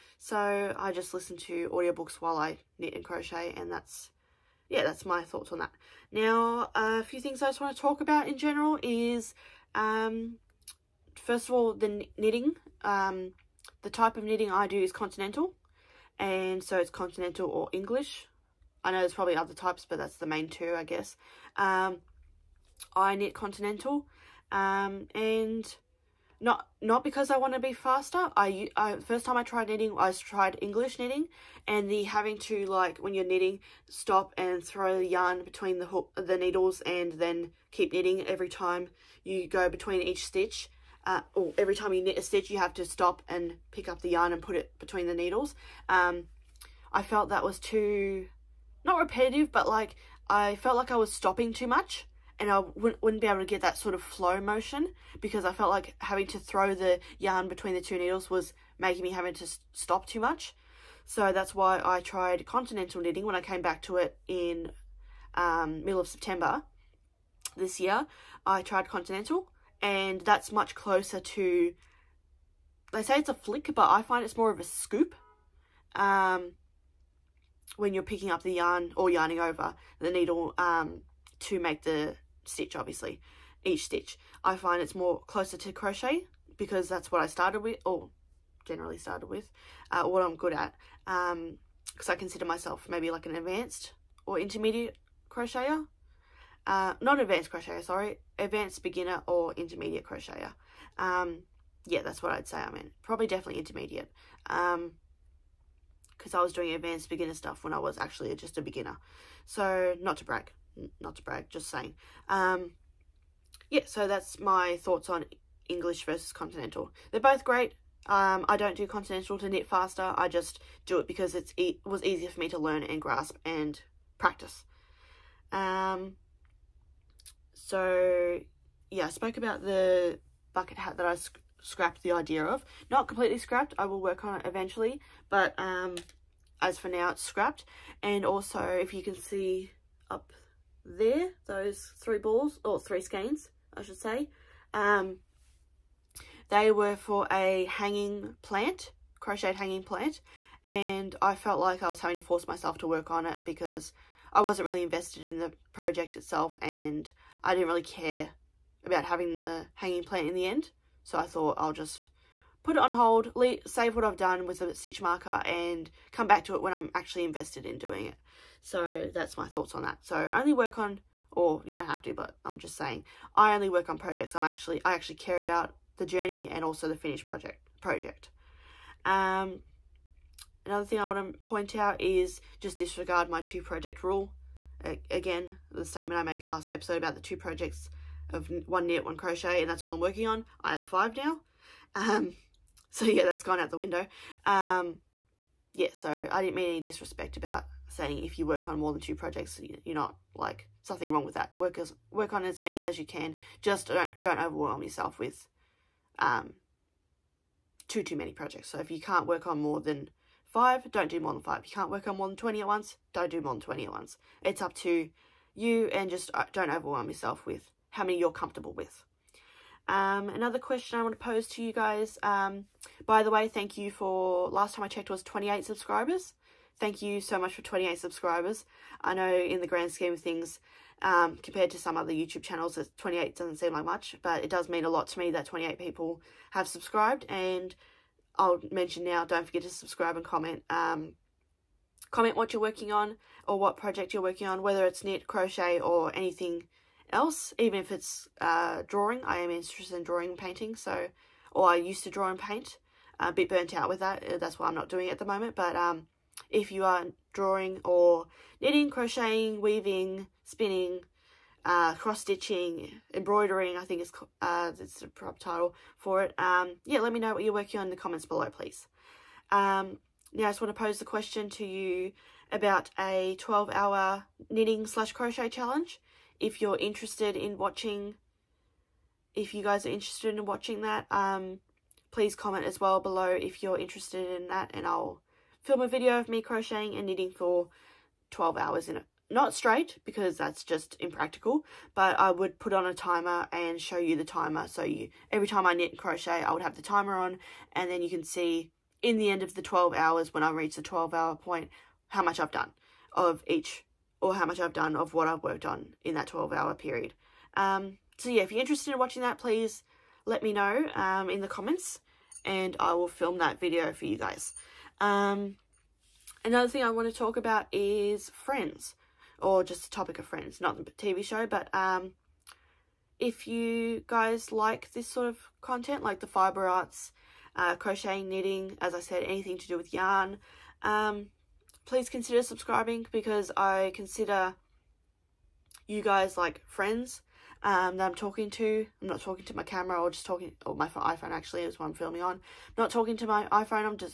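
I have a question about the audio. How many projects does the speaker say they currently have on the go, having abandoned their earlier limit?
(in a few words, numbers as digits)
5.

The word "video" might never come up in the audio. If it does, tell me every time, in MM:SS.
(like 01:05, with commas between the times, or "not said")
04:45, 05:13.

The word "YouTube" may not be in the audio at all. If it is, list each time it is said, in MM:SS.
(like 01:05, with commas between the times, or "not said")
03:52.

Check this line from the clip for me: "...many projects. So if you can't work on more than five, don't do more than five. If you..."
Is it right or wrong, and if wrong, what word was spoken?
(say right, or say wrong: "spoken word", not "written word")
right.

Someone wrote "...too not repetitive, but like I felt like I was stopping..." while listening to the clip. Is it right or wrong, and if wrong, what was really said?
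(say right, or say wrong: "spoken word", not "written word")
right.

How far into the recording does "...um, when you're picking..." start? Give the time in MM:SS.
01:15.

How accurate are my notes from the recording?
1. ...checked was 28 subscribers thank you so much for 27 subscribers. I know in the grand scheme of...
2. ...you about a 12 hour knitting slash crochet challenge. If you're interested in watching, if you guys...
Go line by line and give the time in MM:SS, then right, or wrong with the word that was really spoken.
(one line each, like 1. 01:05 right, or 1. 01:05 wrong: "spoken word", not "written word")
1. 03:44 wrong: "28", not "27"
2. 04:31 right.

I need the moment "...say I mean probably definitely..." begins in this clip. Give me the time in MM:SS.
01:42.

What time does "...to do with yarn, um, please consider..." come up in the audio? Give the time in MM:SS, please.
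05:29.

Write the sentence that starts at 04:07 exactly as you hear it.
Even if it's uh, drawing, I am interested in drawing and painting, so or I used to draw and paint.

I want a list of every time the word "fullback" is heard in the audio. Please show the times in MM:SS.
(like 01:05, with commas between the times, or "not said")
not said.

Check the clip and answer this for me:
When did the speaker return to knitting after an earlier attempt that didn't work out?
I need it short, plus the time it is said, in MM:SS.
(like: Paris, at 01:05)
middle of September, at 01:05.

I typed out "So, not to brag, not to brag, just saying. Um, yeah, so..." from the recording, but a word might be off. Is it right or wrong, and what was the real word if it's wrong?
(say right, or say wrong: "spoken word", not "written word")
right.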